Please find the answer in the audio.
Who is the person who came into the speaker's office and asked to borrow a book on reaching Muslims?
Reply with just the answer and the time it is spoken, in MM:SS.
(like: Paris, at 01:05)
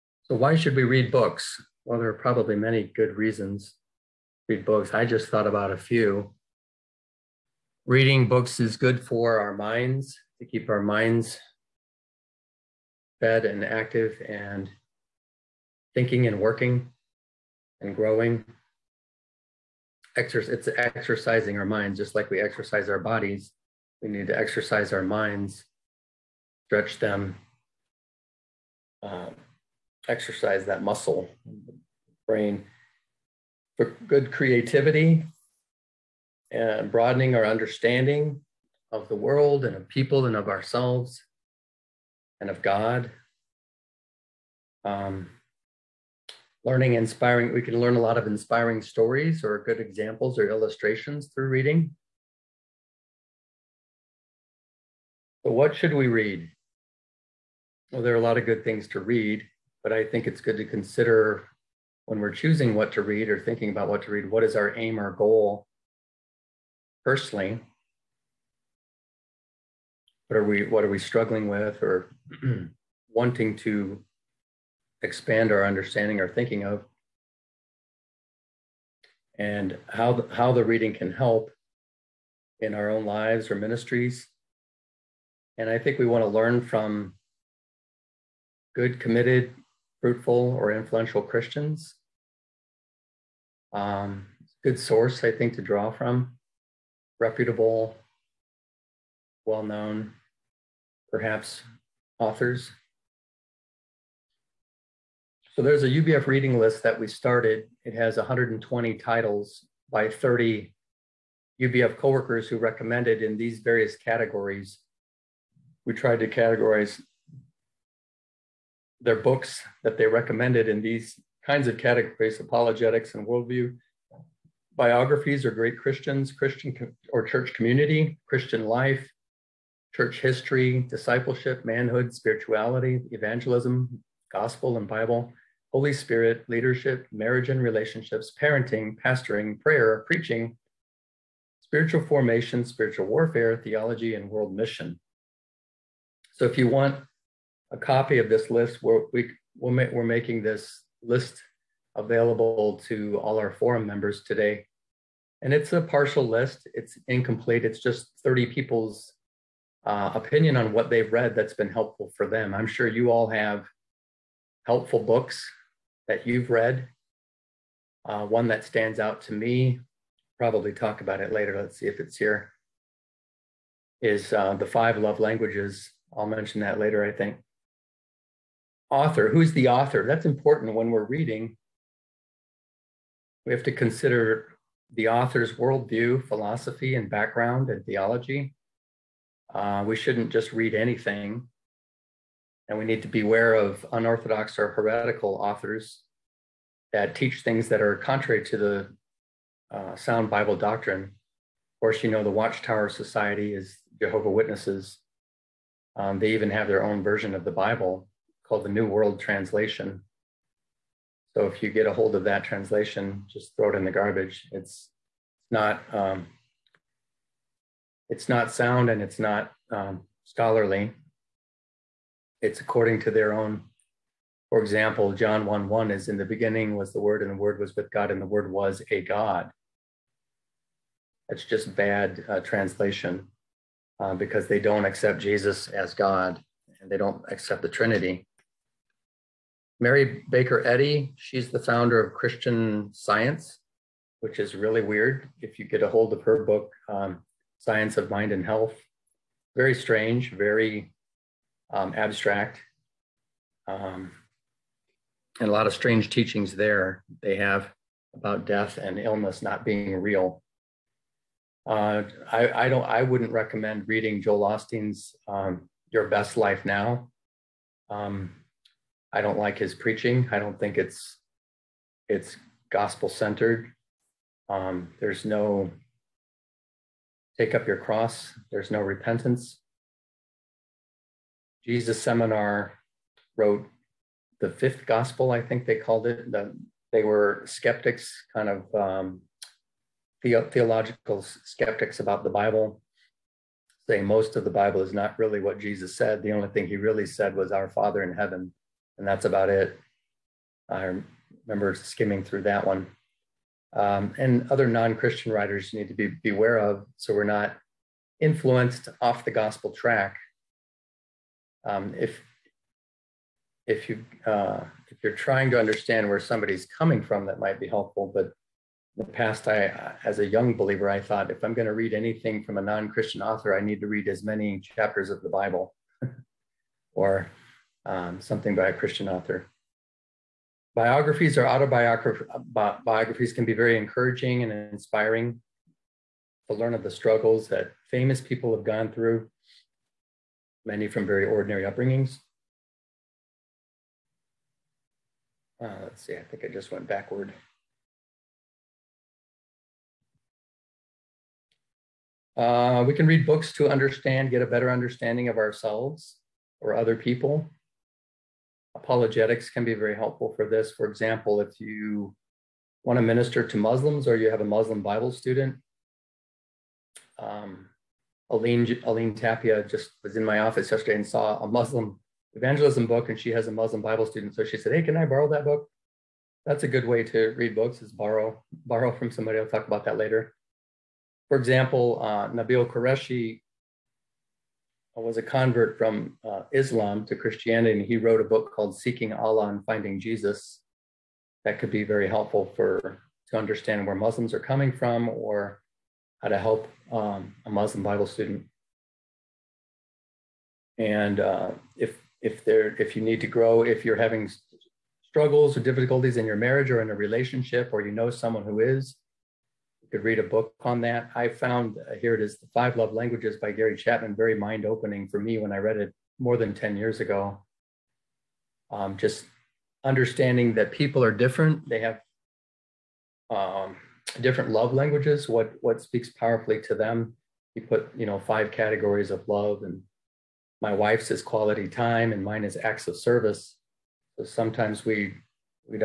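Aline Tapia, at 06:08.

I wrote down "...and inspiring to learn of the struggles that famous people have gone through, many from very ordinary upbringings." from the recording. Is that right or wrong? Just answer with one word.
right.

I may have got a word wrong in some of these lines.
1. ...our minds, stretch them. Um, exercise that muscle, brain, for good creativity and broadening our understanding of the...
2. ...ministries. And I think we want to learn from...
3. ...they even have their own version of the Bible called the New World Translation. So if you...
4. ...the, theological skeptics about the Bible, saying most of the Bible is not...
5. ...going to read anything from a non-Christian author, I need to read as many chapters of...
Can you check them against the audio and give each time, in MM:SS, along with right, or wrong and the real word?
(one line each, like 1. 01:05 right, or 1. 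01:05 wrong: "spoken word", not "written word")
1. 00:24 right
2. 01:23 right
3. 03:26 right
4. 04:50 right
5. 05:21 right.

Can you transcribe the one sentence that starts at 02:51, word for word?
Let's see if it's here, is uh, The Five Love Languages.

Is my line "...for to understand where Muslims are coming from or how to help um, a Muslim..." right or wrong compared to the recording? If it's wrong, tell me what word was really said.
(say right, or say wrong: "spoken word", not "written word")
right.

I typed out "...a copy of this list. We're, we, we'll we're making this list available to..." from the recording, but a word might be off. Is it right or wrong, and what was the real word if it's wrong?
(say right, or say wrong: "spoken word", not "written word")
right.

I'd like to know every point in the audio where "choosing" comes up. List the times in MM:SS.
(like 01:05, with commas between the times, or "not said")
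01:02.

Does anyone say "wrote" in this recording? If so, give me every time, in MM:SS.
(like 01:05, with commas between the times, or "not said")
04:43, 06:27.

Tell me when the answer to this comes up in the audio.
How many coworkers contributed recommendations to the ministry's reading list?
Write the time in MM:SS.
01:50.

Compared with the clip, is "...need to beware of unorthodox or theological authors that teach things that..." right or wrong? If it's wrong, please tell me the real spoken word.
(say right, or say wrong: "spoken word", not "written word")
wrong: "heretical", not "theological".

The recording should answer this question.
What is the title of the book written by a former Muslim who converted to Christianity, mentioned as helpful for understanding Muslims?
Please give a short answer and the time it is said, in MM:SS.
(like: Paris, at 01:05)
Seeking Allah and Finding Jesus, at 06:28.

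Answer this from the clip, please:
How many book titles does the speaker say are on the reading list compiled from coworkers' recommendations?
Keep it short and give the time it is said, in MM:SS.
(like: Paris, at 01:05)
120, at 01:48.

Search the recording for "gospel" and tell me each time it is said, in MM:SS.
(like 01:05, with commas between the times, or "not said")
02:14, 04:32, 04:44, 05:09.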